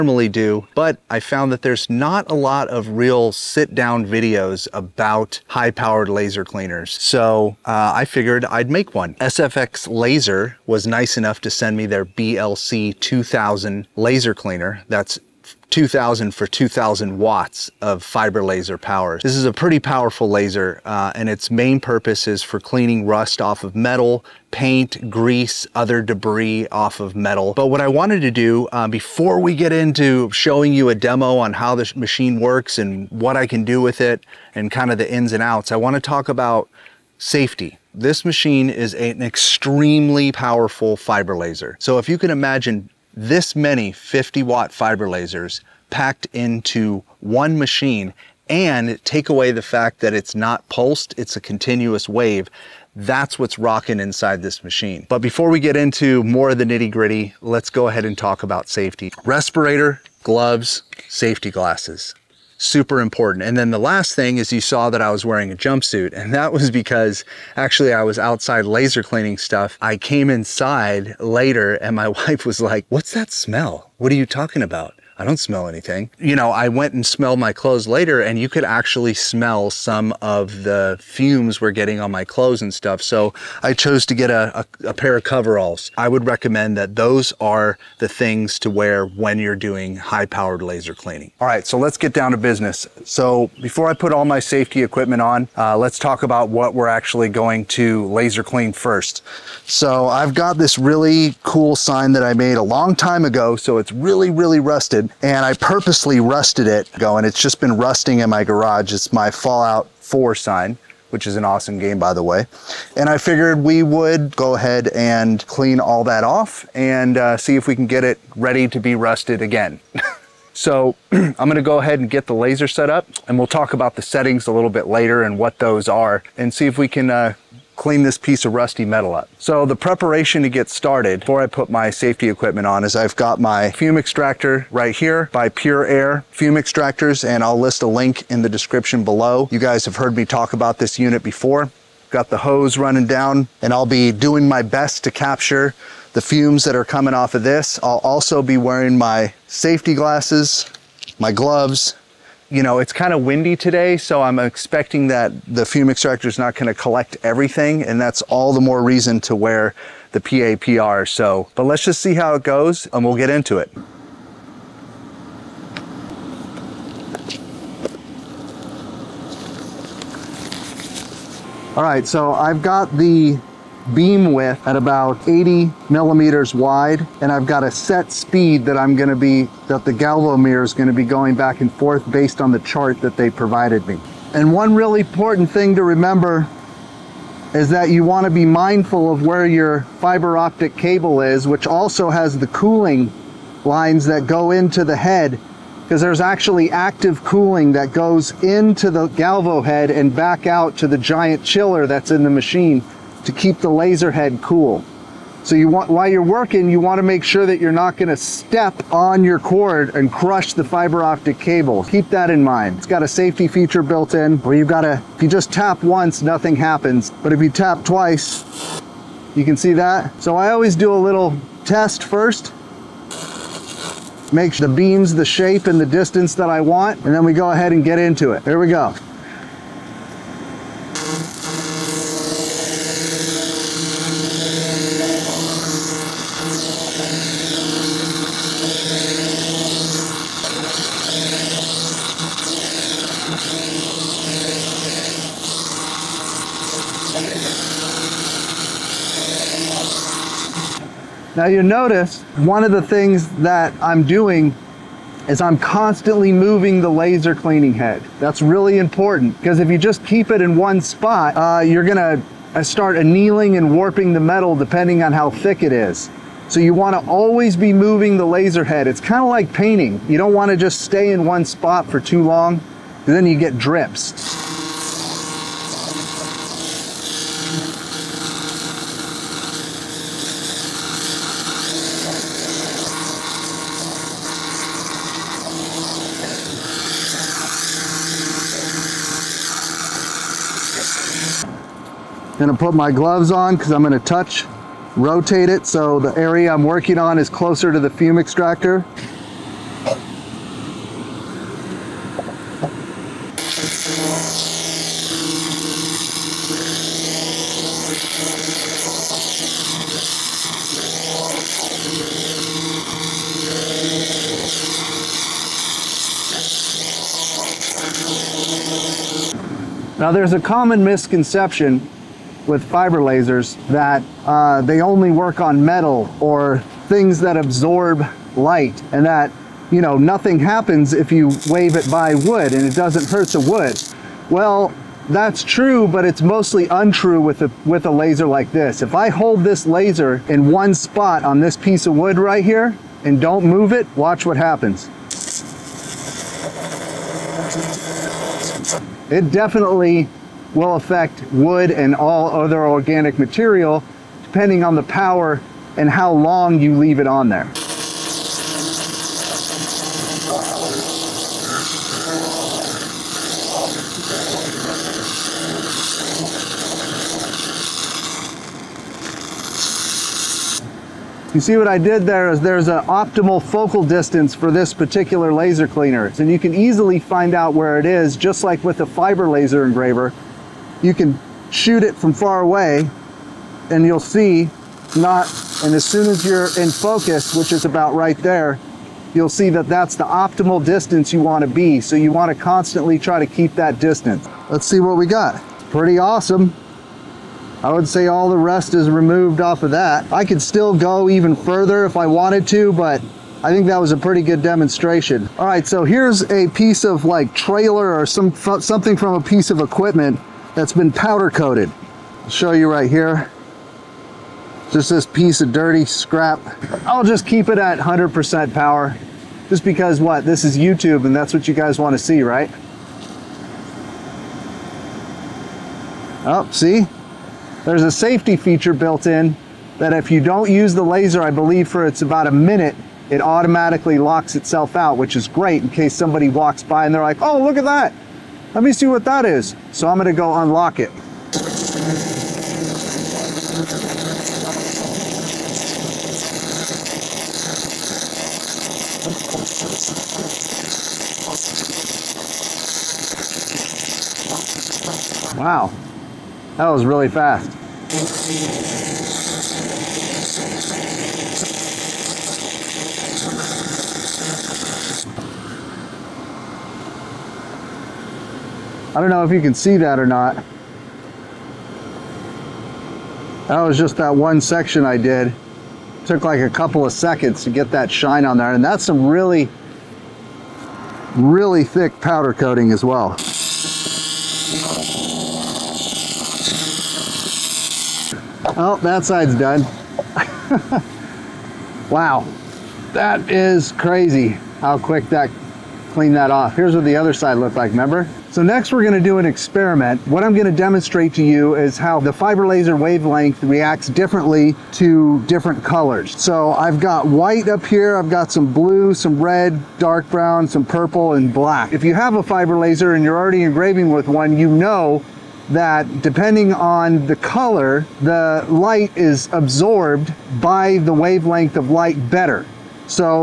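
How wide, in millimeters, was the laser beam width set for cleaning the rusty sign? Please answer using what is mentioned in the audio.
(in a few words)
80.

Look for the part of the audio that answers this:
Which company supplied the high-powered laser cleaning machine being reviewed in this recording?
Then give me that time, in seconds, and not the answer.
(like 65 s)
9 s.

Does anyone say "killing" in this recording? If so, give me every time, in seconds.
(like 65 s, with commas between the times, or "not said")
not said.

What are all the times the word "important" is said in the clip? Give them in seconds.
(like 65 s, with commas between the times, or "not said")
63 s, 185 s, 258 s.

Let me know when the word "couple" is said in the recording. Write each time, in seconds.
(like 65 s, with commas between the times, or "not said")
476 s.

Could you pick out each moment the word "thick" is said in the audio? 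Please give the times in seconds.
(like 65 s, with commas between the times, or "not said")
265 s, 481 s.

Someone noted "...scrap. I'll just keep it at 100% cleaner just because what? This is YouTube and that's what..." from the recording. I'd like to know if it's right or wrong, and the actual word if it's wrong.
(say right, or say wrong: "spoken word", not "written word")
wrong: "power", not "cleaner".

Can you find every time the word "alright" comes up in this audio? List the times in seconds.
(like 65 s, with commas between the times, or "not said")
not said.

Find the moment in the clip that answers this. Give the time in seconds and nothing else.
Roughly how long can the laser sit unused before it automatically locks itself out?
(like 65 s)
432 s.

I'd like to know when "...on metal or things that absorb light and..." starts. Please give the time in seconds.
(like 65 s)
325 s.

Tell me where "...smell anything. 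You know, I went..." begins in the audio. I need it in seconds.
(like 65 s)
75 s.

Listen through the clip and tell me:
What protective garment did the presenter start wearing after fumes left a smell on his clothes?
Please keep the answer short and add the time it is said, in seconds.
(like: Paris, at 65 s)
coveralls, at 85 s.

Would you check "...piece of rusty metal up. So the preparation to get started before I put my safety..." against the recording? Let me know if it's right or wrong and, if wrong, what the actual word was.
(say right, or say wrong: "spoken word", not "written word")
right.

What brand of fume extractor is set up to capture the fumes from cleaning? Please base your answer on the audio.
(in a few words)
Pure Air.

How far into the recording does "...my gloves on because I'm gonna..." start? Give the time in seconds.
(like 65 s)
292 s.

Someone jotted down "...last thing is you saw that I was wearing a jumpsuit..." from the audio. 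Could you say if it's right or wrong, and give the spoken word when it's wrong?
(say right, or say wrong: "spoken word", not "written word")
right.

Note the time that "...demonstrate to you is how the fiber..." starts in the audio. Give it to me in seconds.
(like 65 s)
500 s.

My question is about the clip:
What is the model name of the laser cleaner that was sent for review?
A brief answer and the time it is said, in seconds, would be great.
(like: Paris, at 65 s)
BLC 2000, at 12 s.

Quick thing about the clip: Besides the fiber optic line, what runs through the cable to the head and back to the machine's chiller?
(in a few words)
cooling lines.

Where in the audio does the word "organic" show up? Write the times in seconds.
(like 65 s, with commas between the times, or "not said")
352 s.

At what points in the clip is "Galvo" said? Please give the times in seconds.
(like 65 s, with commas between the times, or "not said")
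179 s, 199 s.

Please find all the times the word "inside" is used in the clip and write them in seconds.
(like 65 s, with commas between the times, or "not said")
54 s, 70 s.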